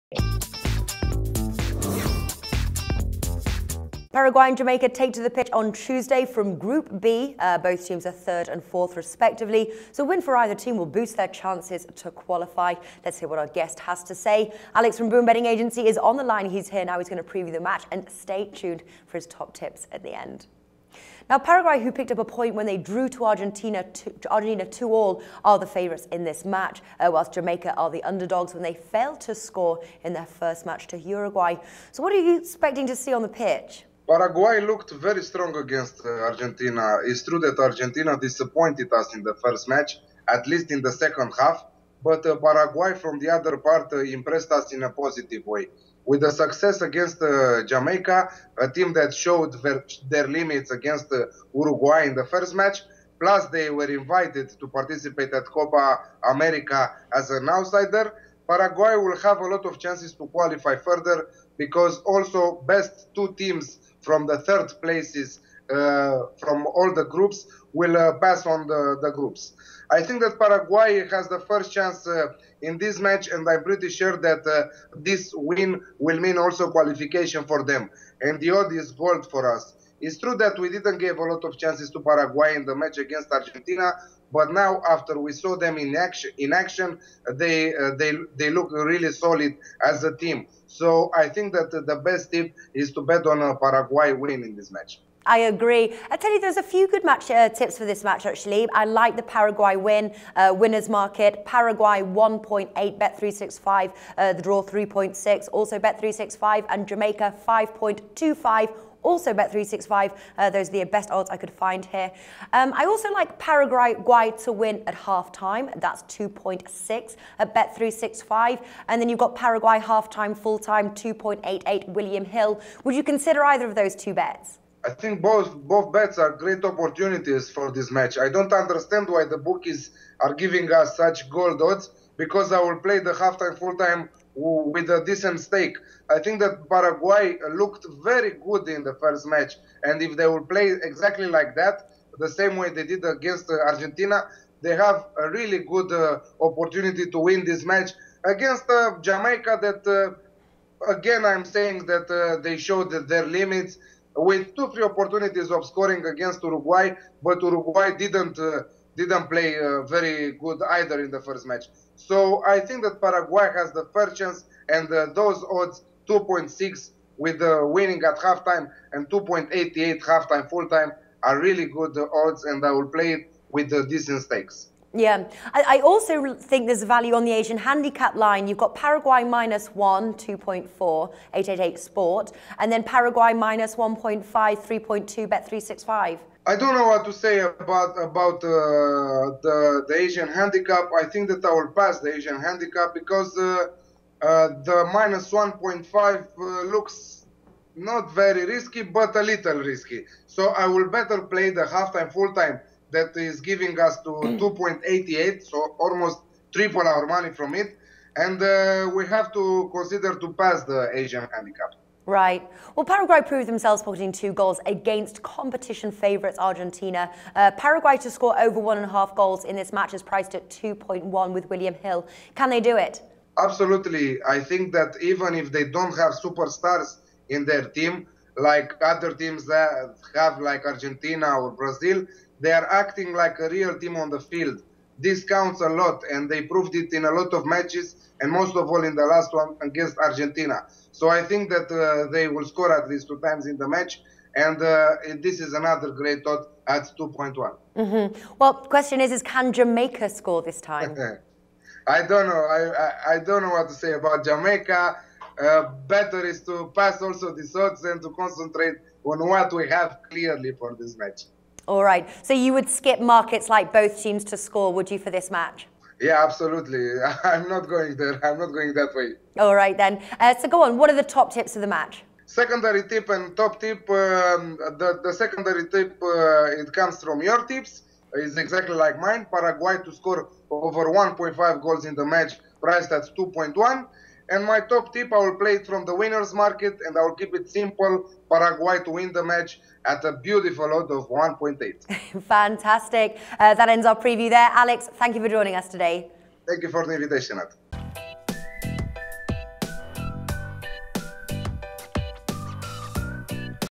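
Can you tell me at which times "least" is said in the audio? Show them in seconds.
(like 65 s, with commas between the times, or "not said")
40 s, 242 s.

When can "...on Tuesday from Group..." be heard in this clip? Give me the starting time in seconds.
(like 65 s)
5 s.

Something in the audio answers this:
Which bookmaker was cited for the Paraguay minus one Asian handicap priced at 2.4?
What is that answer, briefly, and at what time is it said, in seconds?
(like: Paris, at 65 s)
888 Sport, at 181 s.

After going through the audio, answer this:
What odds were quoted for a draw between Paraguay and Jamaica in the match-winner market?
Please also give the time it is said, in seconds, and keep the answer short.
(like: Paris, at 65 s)
3.6, at 104 s.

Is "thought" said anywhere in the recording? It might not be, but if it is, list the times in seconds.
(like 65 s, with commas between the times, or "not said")
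246 s, 257 s.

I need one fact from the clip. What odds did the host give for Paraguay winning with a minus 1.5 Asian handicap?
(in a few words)
3.2.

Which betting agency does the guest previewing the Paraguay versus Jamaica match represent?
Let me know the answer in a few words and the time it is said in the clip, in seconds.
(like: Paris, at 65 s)
Boom Betting Agency, at 15 s.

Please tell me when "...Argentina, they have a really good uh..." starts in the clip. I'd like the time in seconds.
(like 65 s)
143 s.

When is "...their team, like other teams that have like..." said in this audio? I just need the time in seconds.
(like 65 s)
227 s.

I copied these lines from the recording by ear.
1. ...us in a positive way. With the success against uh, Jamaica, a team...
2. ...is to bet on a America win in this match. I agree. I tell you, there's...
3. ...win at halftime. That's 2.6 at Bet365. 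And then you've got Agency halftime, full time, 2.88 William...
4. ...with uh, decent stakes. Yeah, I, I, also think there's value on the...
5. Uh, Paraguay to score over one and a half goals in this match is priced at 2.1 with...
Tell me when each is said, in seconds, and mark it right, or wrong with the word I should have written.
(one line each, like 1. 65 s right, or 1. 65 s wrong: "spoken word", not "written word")
1. 44 s right
2. 92 s wrong: "Paraguay", not "America"
3. 114 s wrong: "Paraguay", not "Agency"
4. 173 s right
5. 217 s right.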